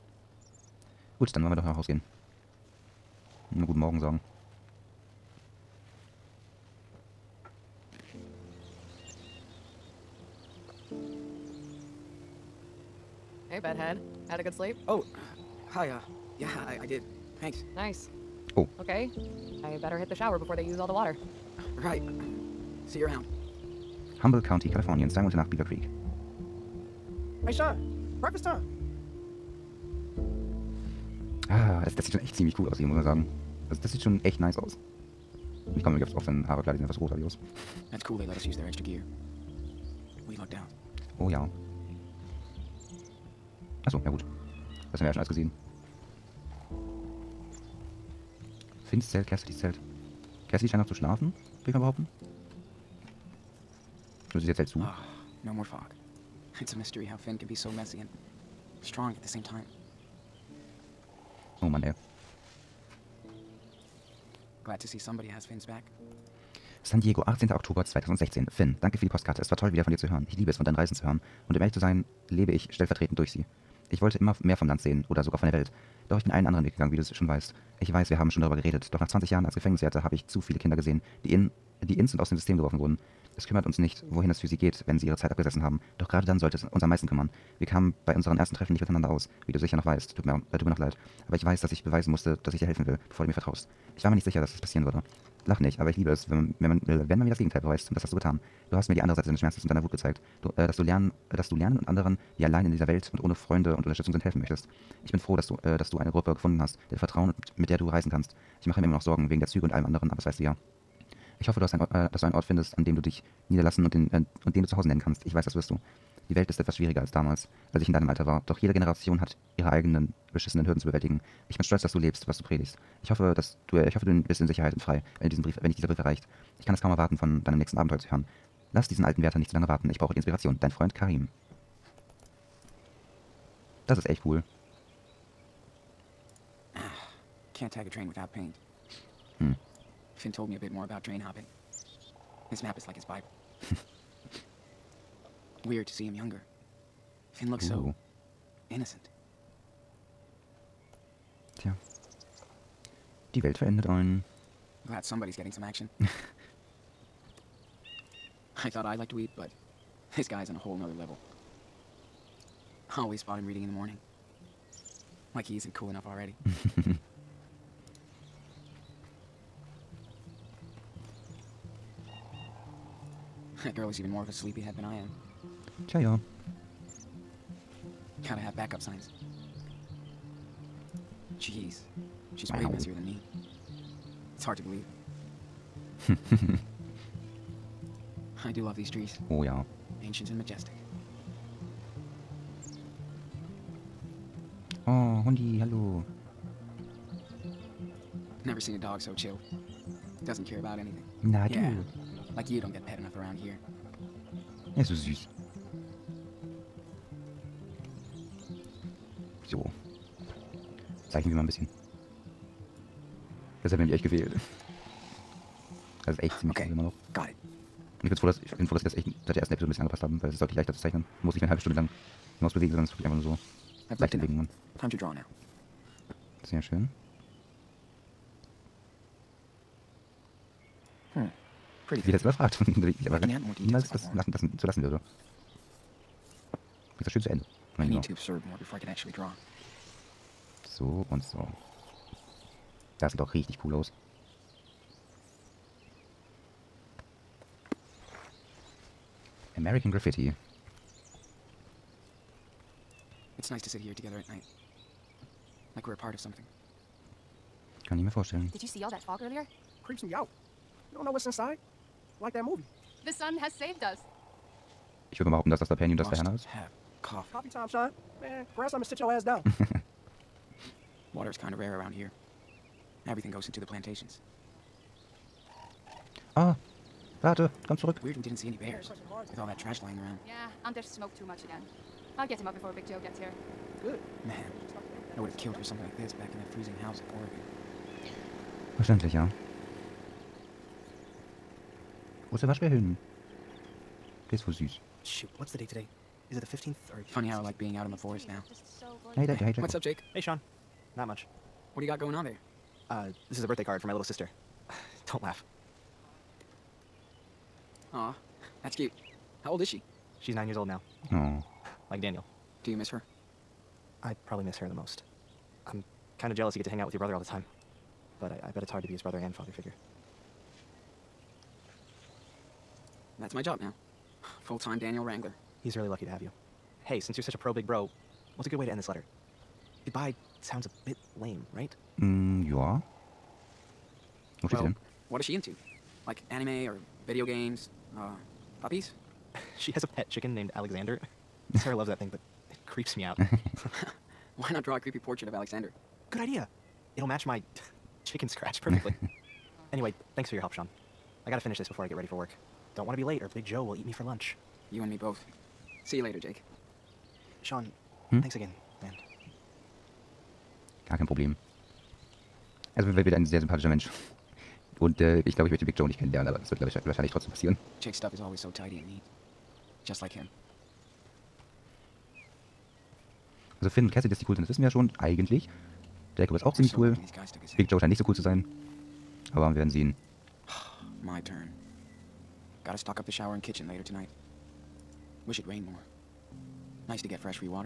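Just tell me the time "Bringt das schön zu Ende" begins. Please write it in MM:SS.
03:56.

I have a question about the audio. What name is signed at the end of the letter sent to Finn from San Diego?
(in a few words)
Karim.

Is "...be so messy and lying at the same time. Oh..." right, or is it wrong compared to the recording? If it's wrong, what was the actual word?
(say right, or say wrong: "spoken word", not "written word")
wrong: "strong", not "lying".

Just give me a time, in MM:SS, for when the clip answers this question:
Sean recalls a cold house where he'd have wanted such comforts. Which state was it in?
04:47.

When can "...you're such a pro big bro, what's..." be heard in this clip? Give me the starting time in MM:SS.
05:27.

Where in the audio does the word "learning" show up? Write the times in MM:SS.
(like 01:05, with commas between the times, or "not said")
not said.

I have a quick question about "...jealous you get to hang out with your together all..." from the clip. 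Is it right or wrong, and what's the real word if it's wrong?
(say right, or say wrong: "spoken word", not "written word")
wrong: "brother", not "together".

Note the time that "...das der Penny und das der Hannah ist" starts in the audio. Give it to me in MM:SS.
04:25.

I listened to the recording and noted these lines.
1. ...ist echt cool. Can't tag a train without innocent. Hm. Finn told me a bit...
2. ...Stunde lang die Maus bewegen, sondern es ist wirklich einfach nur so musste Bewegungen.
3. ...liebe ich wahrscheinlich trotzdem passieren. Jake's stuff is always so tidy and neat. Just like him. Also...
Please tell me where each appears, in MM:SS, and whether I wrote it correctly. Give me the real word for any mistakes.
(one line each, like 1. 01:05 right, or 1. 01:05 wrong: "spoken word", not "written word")
1. 02:13 wrong: "paint", not "innocent"
2. 03:41 wrong: "leichte", not "musste"
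3. 06:06 wrong: "glaube", not "liebe".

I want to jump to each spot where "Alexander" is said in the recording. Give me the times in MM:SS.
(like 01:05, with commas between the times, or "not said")
05:40, 05:45.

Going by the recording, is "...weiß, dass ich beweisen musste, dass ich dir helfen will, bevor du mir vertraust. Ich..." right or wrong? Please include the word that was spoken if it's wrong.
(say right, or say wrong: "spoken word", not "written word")
right.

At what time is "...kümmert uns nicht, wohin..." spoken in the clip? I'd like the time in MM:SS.
01:23.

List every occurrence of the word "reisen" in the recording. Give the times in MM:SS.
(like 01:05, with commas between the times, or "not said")
01:10, 01:47.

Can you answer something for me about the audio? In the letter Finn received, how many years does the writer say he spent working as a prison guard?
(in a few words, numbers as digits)
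20.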